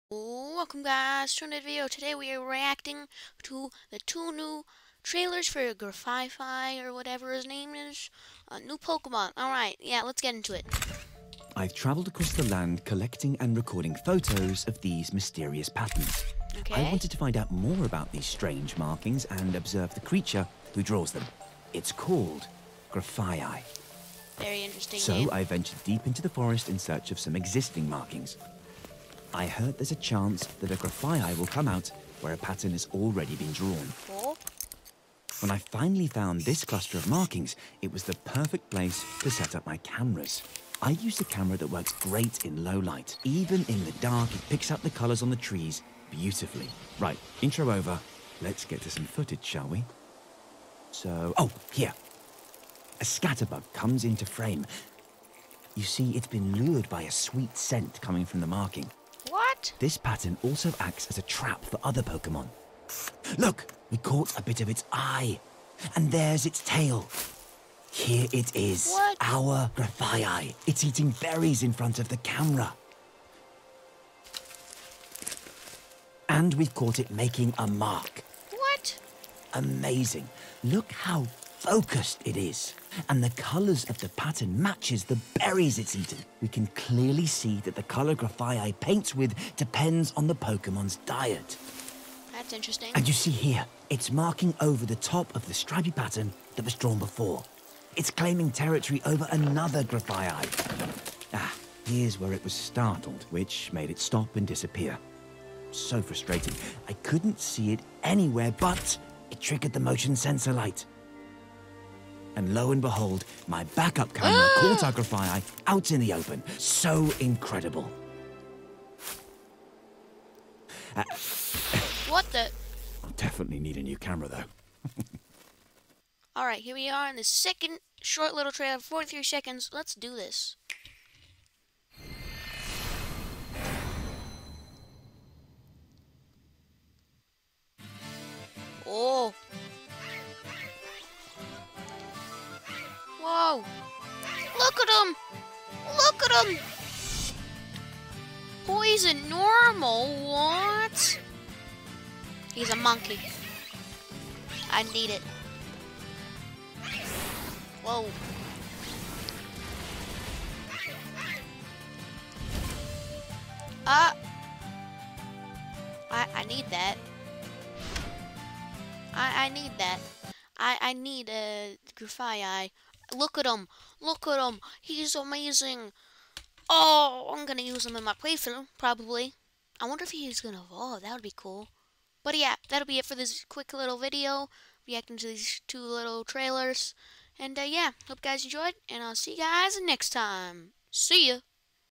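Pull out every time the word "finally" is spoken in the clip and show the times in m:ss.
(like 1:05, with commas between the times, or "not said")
0:35.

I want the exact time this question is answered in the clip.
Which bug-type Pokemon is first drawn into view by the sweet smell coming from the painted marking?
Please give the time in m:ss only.
0:53.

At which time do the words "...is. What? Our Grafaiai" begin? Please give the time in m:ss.
1:08.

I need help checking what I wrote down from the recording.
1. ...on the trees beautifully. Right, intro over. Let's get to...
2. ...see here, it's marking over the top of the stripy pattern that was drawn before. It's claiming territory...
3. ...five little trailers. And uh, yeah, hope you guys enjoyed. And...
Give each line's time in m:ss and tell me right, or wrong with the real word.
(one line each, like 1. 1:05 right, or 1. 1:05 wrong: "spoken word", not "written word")
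1. 0:45 right
2. 1:33 right
3. 3:05 wrong: "two", not "five".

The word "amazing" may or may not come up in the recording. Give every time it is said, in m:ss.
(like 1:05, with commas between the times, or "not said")
1:19, 2:55.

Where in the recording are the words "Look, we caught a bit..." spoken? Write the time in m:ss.
1:03.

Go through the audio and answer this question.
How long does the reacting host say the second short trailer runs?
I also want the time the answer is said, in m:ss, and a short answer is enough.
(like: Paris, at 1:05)
43 seconds, at 2:08.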